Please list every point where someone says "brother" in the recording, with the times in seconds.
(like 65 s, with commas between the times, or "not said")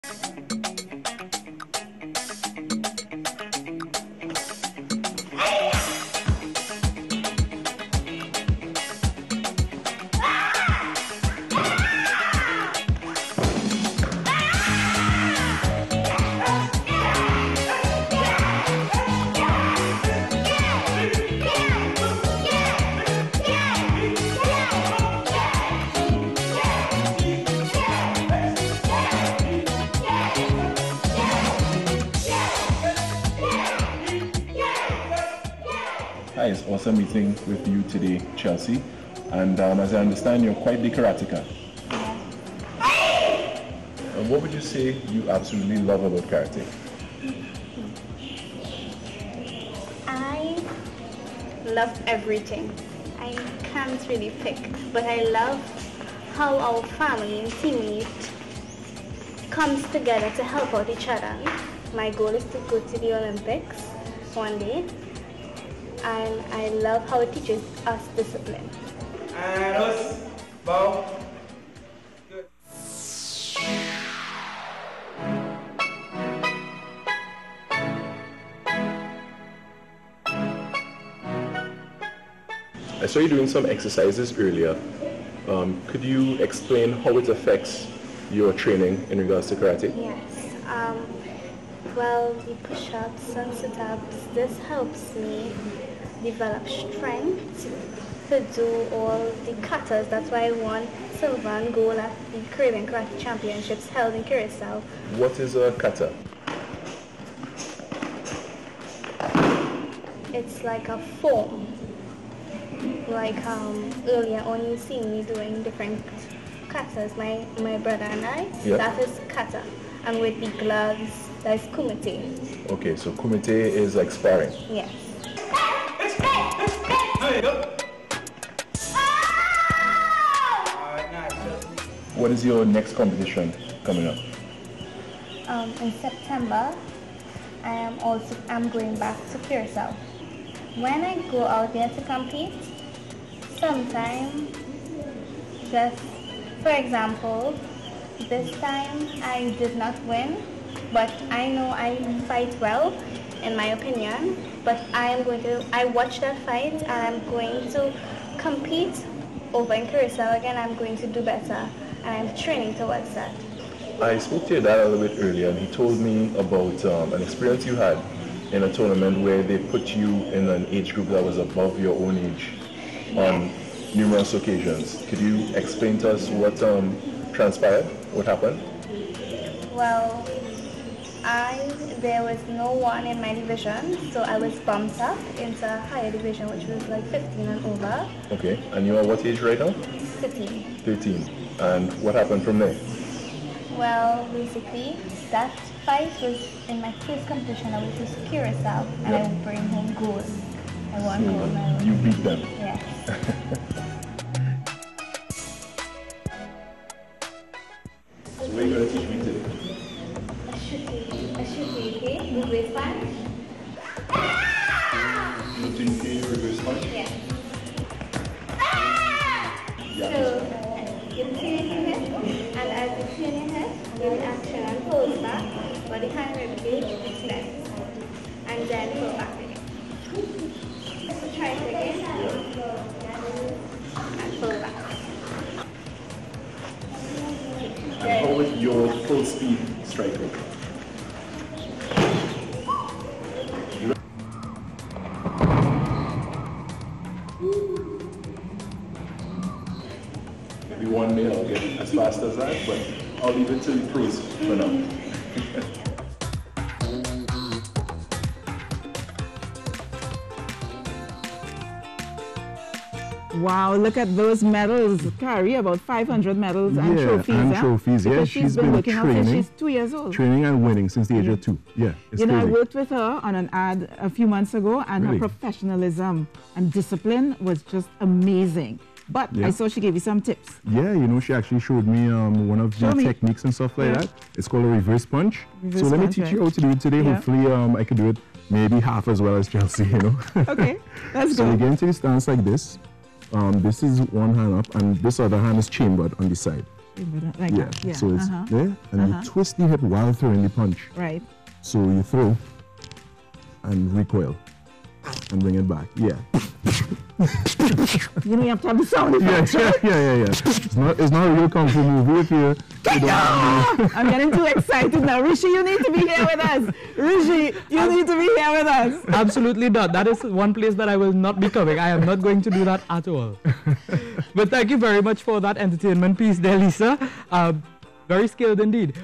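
117 s.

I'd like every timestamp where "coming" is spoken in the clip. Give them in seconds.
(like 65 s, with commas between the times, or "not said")
133 s, 321 s.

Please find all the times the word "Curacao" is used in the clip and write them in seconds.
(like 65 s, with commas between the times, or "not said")
104 s, 139 s, 159 s, 198 s.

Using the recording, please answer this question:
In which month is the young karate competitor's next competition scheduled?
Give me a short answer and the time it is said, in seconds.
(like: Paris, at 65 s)
September, at 135 s.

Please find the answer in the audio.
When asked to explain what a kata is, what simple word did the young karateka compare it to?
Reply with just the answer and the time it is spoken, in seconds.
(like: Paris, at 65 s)
a form, at 111 s.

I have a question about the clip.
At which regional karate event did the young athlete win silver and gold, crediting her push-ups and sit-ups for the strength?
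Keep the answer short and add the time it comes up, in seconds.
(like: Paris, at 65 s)
Caribbean Karate Championships, at 102 s.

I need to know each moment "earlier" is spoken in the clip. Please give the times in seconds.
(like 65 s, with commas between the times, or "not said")
84 s, 114 s, 165 s.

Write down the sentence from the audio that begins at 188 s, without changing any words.
Okay, and you are what age right now?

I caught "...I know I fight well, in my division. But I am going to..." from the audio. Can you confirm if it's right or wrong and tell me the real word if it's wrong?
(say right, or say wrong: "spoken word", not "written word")
wrong: "opinion", not "division".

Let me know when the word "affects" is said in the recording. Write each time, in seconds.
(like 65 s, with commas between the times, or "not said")
87 s.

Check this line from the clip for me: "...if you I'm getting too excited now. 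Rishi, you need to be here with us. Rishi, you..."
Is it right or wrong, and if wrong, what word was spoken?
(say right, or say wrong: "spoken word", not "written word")
right.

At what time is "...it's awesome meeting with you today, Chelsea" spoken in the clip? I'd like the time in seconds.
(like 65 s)
36 s.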